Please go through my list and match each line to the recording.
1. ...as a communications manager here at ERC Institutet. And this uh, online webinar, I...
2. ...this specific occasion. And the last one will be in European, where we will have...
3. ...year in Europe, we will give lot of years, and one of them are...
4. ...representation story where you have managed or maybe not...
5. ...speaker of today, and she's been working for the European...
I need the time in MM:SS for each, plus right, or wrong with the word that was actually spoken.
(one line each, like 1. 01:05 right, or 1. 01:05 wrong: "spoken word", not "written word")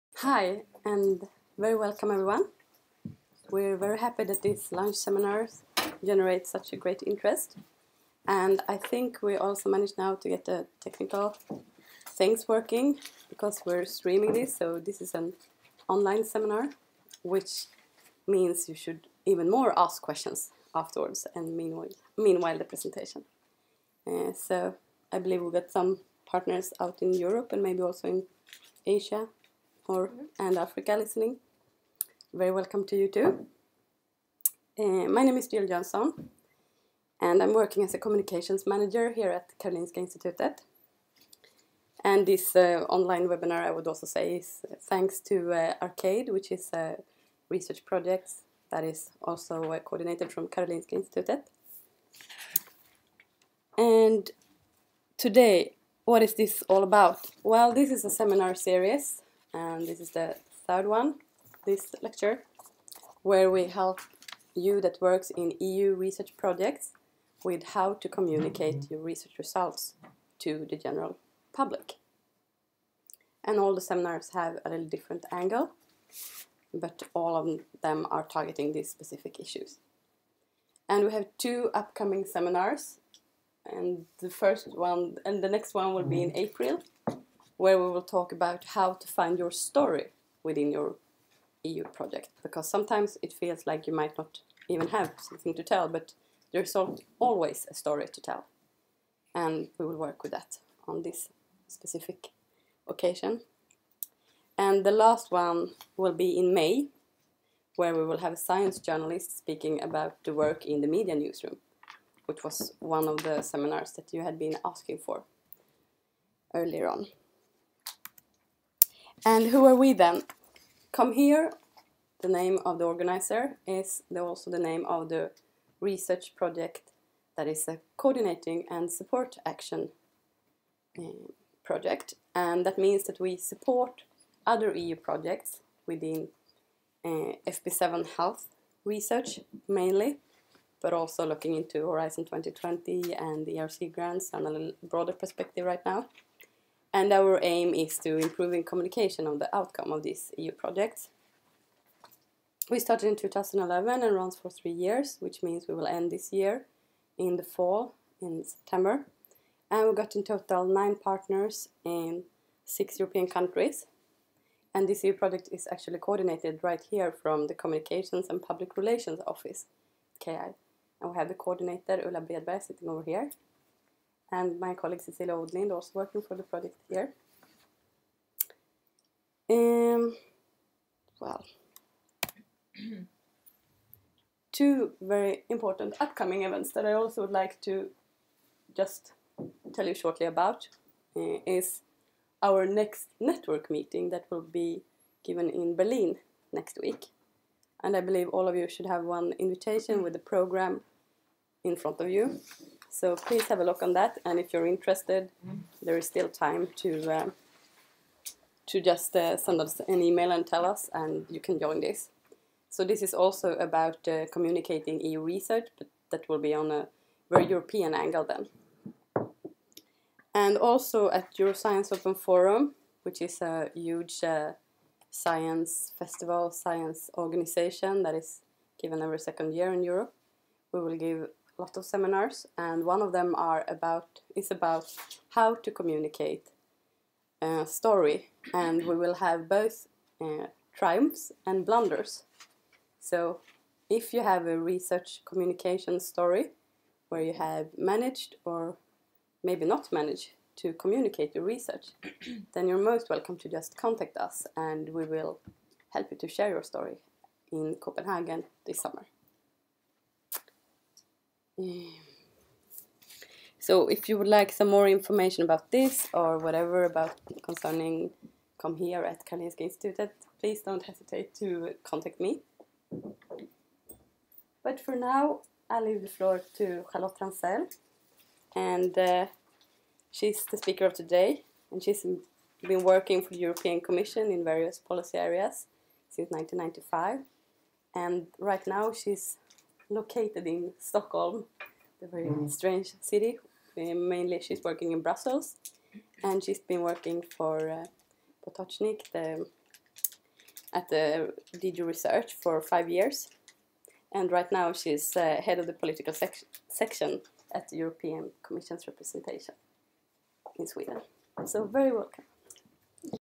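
1. 00:37 wrong: "Karolinska", not "ERC"
2. 01:41 wrong: "May", not "European"
3. 03:49 wrong: "seminars", not "years"
4. 04:05 wrong: "communication", not "representation"
5. 04:40 right.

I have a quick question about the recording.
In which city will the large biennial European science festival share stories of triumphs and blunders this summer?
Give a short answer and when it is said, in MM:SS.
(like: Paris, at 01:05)
Copenhagen, at 04:17.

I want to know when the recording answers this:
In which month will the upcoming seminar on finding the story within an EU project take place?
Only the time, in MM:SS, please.
01:26.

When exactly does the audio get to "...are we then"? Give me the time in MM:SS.
01:59.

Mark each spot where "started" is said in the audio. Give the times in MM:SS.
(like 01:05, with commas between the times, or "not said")
02:32.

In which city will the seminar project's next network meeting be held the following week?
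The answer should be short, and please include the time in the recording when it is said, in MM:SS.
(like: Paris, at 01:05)
Berlin, at 03:15.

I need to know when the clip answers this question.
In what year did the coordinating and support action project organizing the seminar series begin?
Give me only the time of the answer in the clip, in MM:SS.
02:33.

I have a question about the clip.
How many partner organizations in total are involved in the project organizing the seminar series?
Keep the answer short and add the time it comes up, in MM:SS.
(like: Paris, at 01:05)
9, at 02:40.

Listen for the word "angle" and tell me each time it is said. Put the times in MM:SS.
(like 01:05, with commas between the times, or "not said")
01:15, 03:37.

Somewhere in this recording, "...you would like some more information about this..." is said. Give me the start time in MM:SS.
04:24.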